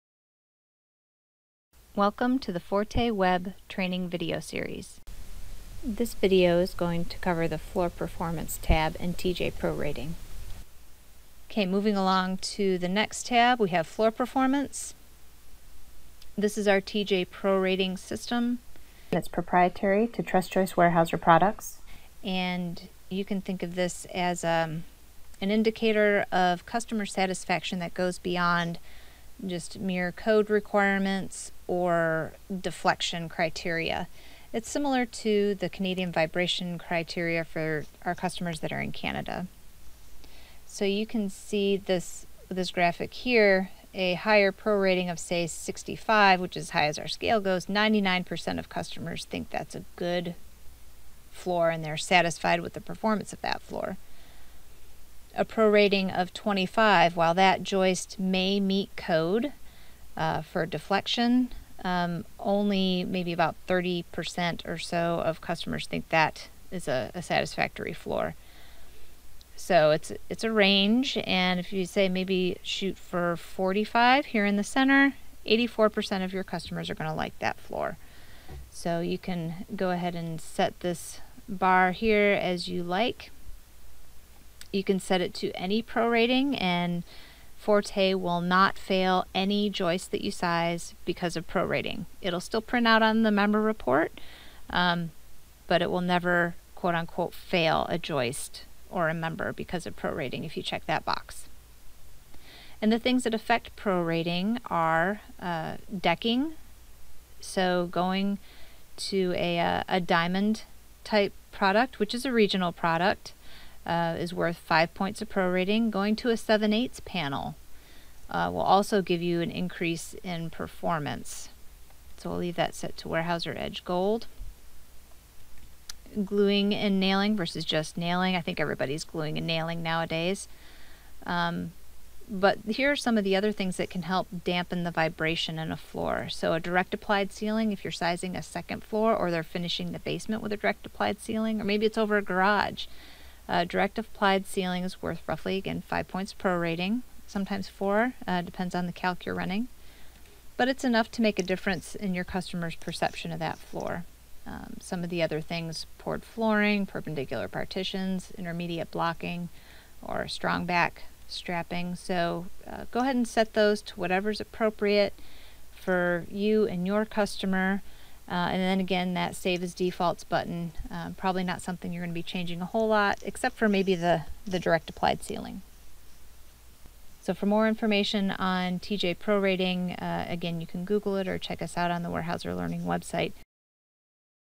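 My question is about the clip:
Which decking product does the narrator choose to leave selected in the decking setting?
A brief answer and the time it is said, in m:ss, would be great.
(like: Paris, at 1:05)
Weyerhaeuser Edge Gold, at 2:03.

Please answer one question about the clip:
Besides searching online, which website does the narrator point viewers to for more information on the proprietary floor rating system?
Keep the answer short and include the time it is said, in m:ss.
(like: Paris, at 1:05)
Weyerhaeuser Learning website, at 3:02.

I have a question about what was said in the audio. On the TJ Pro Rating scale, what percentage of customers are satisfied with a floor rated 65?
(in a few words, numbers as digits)
99%.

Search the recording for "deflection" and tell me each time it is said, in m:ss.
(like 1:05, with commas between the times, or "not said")
0:32, 1:00.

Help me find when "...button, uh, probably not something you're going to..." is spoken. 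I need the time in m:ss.
2:50.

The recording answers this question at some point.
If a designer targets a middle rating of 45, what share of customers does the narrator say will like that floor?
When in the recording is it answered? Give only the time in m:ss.
1:15.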